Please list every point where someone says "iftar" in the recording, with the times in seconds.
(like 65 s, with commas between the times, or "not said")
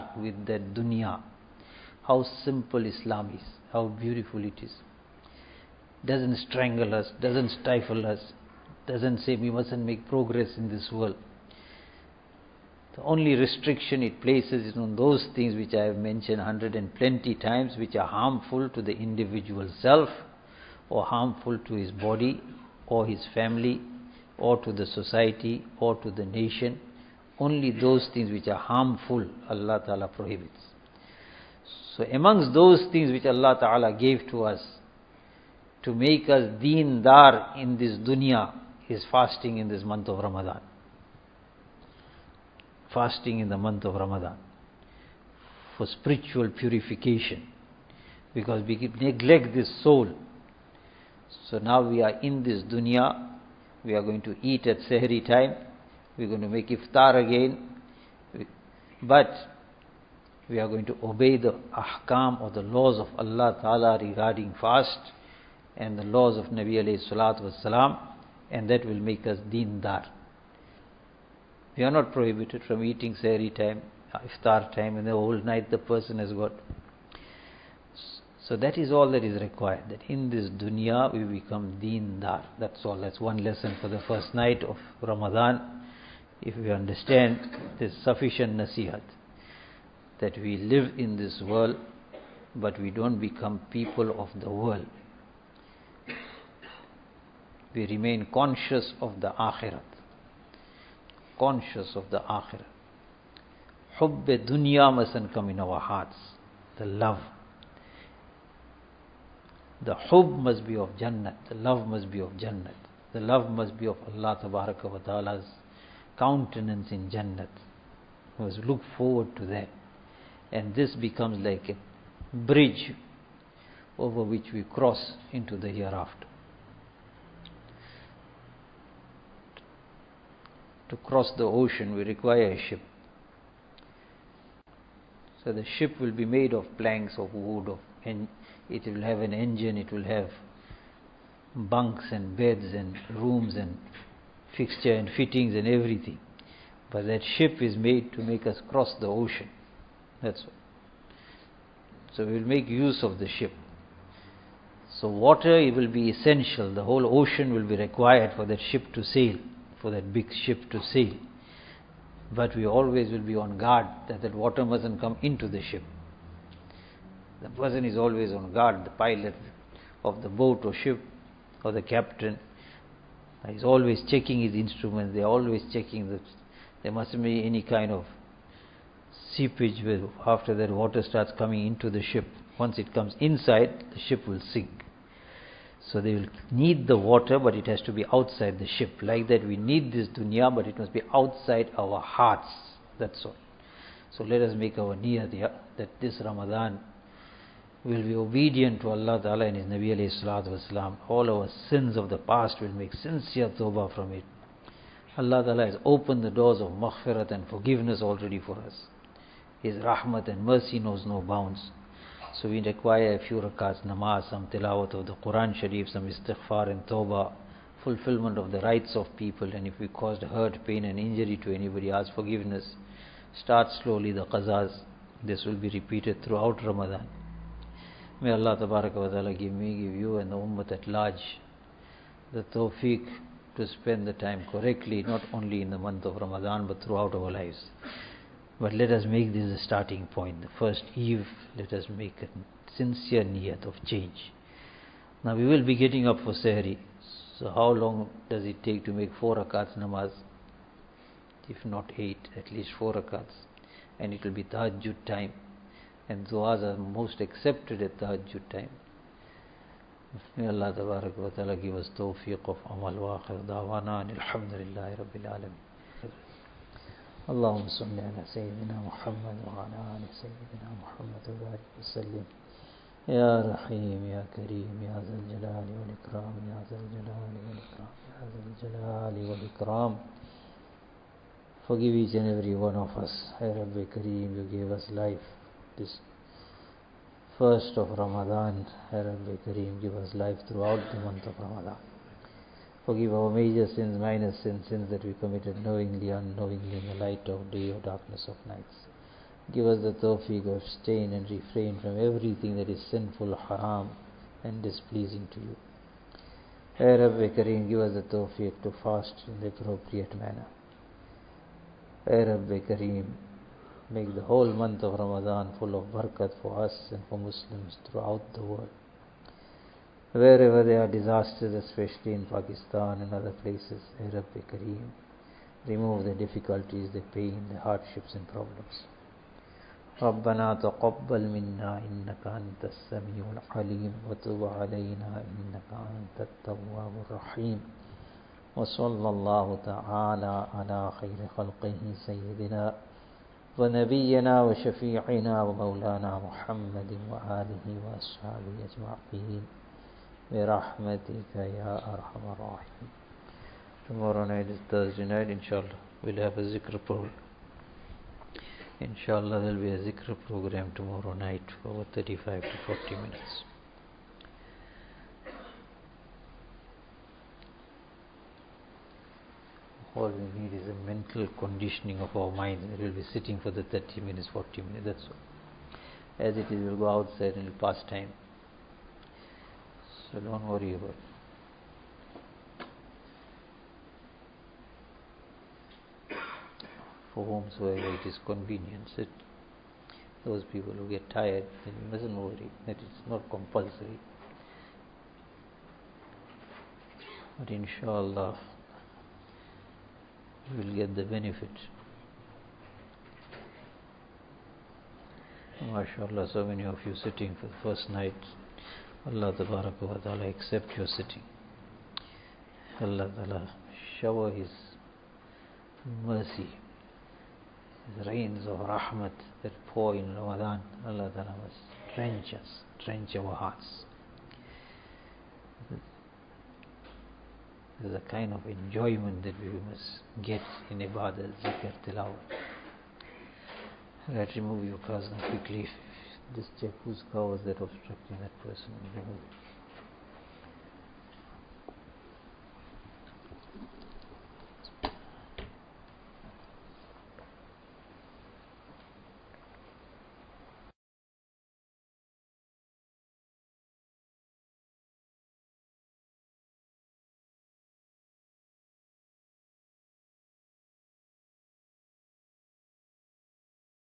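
56 s, 74 s.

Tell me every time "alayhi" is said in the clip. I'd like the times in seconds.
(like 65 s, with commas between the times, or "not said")
66 s, 199 s.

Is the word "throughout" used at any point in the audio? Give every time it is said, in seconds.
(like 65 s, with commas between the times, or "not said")
226 s, 236 s, 290 s, 317 s.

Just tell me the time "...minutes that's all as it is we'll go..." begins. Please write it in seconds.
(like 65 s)
374 s.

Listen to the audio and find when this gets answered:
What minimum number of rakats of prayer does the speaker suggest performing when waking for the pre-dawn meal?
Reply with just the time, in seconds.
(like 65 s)
252 s.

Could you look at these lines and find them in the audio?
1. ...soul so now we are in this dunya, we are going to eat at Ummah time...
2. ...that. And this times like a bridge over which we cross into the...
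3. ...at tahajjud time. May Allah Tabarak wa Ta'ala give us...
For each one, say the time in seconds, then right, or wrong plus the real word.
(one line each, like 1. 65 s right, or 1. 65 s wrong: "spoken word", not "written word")
1. 49 s wrong: "Sahri", not "Ummah"
2. 119 s wrong: "becomes", not "times"
3. 257 s right.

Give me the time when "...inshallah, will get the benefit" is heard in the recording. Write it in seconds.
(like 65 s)
397 s.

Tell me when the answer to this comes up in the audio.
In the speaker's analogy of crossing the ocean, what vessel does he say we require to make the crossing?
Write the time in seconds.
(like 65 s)
131 s.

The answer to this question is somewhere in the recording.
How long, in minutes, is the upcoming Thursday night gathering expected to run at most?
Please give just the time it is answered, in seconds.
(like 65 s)
361 s.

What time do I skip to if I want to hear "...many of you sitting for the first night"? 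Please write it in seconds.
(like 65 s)
406 s.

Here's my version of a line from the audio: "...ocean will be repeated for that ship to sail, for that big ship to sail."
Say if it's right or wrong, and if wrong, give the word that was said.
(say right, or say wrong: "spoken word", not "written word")
wrong: "required", not "repeated".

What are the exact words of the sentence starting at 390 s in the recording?
those people who get tired, then you mustn't worry that it's not compulsory.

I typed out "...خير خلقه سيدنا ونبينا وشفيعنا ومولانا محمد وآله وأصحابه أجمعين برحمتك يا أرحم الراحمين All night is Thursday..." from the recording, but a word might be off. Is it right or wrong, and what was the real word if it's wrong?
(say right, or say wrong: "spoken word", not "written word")
wrong: "Tomorrow", not "All".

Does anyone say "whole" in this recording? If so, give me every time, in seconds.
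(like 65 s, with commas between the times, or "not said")
75 s, 156 s, 314 s.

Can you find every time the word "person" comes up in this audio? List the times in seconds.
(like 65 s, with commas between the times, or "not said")
75 s, 167 s, 438 s.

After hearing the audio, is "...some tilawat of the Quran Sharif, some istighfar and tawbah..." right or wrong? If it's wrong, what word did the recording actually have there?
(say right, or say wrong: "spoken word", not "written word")
right.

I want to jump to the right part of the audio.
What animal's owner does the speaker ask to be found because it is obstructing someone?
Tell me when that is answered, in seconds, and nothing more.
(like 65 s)
437 s.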